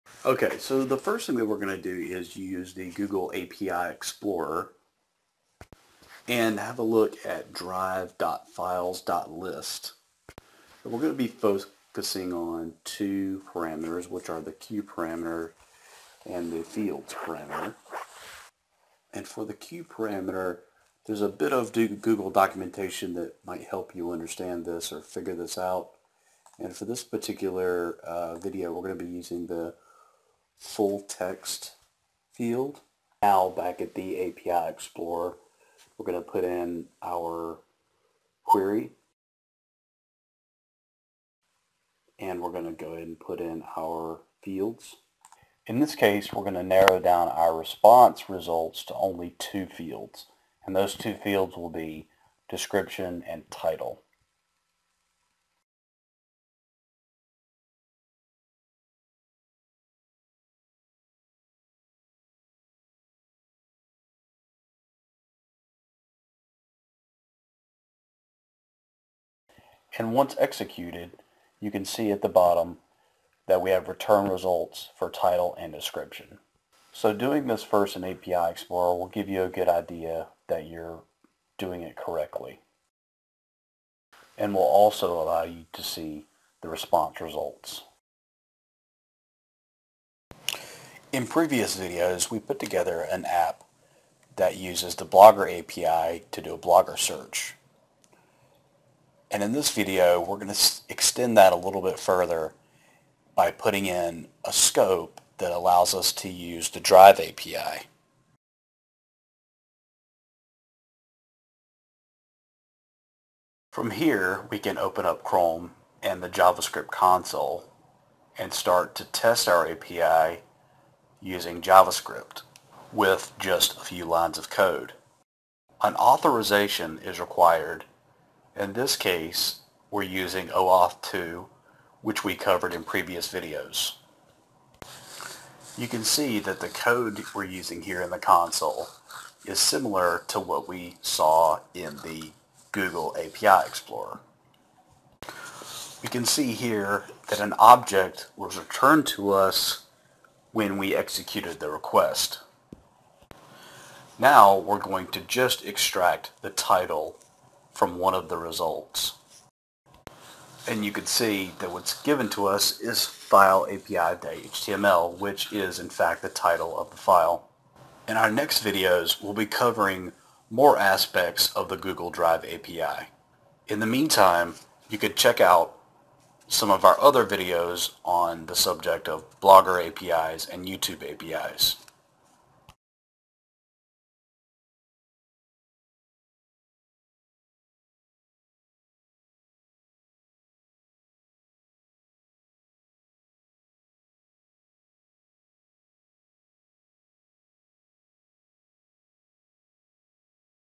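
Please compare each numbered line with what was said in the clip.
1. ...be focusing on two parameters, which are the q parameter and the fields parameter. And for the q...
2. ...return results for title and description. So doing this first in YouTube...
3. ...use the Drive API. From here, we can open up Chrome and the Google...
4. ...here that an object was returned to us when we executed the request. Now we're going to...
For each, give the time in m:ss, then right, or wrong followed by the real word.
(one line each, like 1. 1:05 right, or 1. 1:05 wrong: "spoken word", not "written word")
1. 0:11 right
2. 1:13 wrong: "API", not "YouTube"
3. 1:46 wrong: "JavaScript", not "Google"
4. 2:26 right.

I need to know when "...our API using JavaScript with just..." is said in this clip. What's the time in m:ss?
1:59.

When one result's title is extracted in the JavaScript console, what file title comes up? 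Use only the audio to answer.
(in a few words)
file api.html.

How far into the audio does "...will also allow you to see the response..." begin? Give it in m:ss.
1:24.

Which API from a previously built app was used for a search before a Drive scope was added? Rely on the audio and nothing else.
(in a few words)
Blogger API.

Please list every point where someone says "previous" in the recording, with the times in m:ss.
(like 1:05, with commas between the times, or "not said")
1:31, 2:12.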